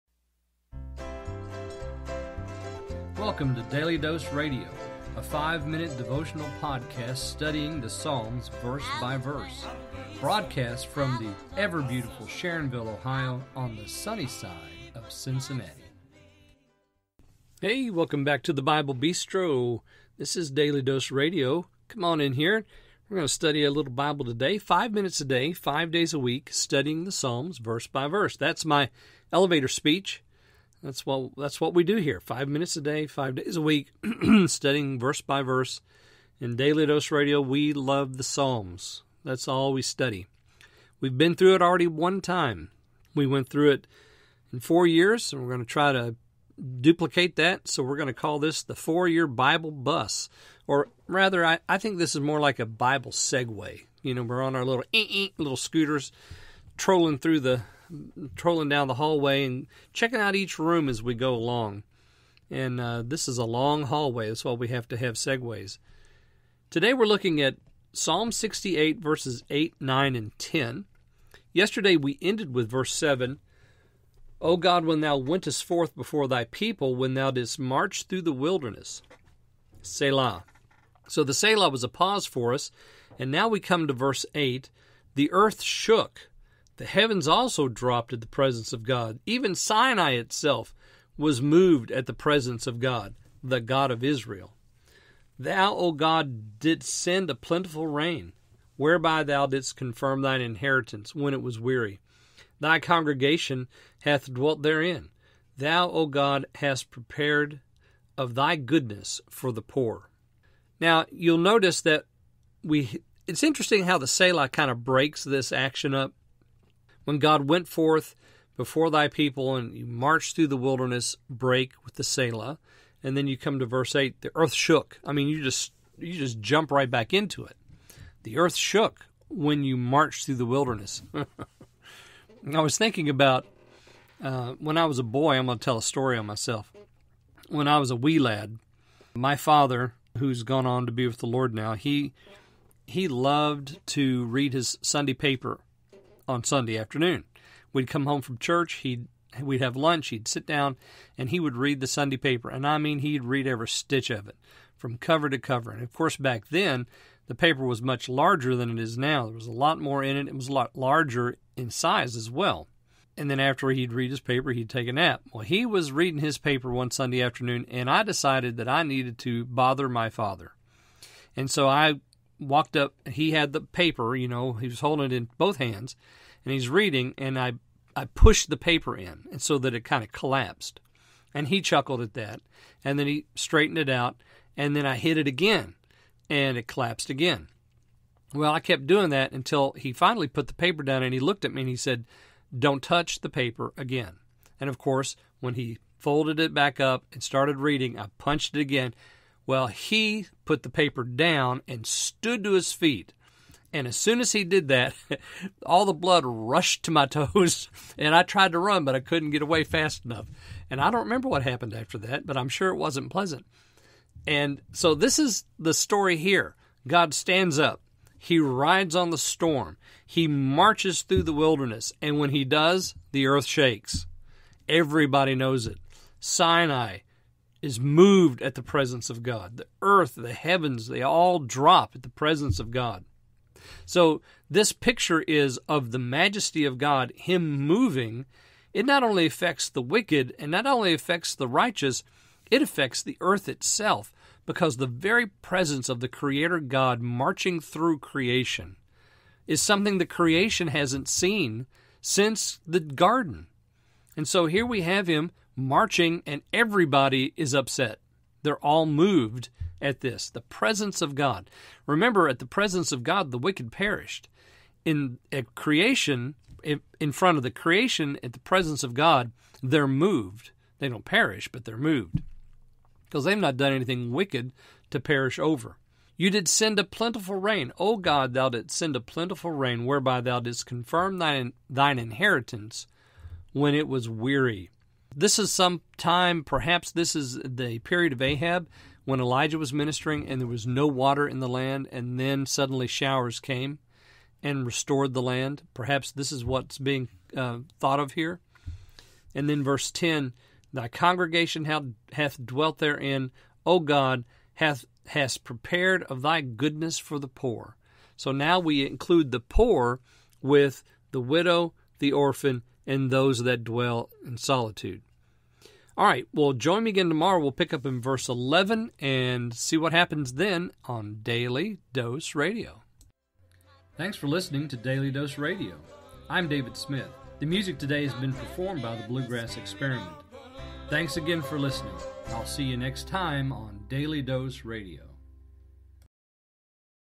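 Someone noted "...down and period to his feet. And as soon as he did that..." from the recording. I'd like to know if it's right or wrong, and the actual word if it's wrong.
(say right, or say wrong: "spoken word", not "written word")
wrong: "stood", not "period".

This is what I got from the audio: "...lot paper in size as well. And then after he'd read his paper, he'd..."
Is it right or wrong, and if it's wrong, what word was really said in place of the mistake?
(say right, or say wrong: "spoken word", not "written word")
wrong: "larger", not "paper".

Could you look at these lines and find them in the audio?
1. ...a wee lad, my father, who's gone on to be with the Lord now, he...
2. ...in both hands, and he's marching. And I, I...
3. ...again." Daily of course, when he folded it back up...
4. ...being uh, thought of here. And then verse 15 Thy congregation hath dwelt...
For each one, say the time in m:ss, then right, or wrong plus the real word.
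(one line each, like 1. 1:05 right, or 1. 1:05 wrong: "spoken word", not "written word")
1. 2:17 right
2. 2:55 wrong: "reading", not "marching"
3. 3:13 wrong: "And", not "Daily"
4. 4:56 wrong: "10", not "15".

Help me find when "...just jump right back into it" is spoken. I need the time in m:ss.
2:06.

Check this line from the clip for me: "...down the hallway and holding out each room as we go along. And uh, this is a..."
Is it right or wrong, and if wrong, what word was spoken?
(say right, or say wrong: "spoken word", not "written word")
wrong: "checking", not "holding".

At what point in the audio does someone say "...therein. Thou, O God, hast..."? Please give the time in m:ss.
1:44.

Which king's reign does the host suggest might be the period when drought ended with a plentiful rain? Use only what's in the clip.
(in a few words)
Ahab.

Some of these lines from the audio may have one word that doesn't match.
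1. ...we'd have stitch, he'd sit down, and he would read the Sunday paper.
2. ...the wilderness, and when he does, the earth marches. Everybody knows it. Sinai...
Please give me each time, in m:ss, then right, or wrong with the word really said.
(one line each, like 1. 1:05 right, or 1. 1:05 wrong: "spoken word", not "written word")
1. 2:29 wrong: "lunch", not "stitch"
2. 3:41 wrong: "shakes", not "marches".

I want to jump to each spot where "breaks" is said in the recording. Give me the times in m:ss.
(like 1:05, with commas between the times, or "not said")
1:54, 2:01.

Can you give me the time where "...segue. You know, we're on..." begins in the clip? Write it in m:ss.
0:53.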